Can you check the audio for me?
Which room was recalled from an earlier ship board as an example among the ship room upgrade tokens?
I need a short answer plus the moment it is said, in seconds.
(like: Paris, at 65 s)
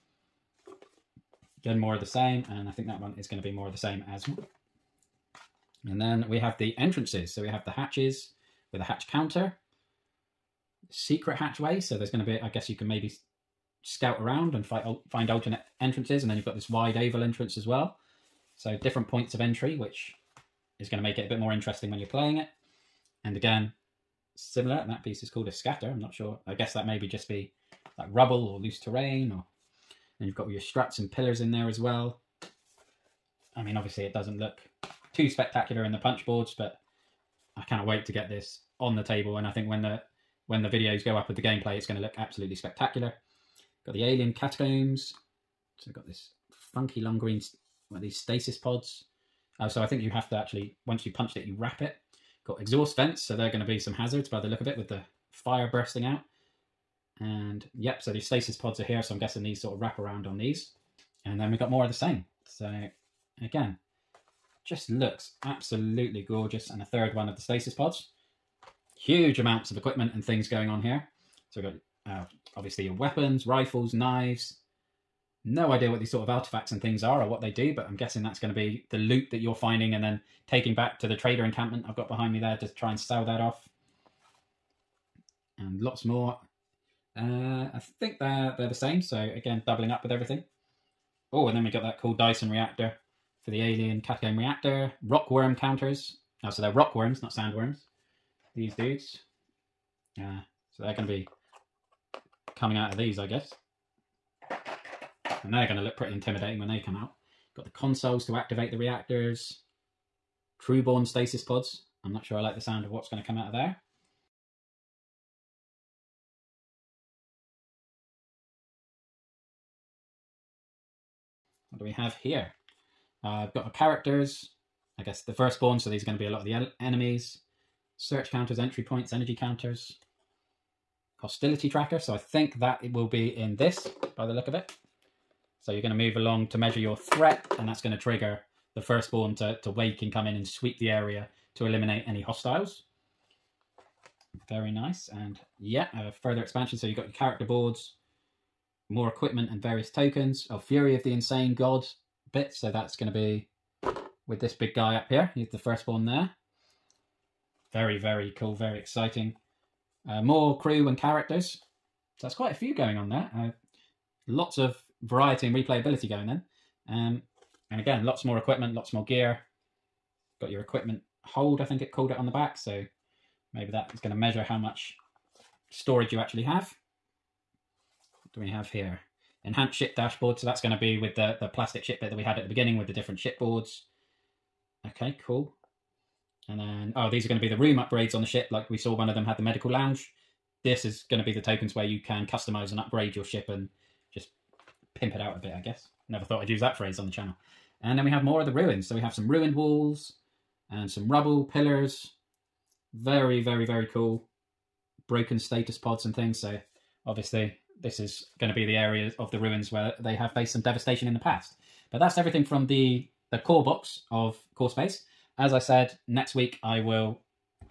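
Medical lounge, at 189 s.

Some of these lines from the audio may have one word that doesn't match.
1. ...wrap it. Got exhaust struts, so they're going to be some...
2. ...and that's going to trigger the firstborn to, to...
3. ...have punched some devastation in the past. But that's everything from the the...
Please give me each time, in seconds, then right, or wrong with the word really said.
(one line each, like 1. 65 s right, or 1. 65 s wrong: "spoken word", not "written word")
1. 51 s wrong: "vents", not "struts"
2. 137 s right
3. 210 s wrong: "faced", not "punched".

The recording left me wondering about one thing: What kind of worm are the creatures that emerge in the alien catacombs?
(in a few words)
Rockworms.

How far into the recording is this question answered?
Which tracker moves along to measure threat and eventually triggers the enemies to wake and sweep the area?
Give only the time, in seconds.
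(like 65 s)
131 s.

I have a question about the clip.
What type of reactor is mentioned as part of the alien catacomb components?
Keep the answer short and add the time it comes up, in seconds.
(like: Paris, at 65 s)
Dyson reactor, at 92 s.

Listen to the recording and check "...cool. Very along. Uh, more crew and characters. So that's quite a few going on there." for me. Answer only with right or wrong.
wrong.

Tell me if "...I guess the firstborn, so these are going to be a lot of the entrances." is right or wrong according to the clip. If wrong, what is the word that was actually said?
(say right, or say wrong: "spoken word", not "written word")
wrong: "enemies", not "entrances".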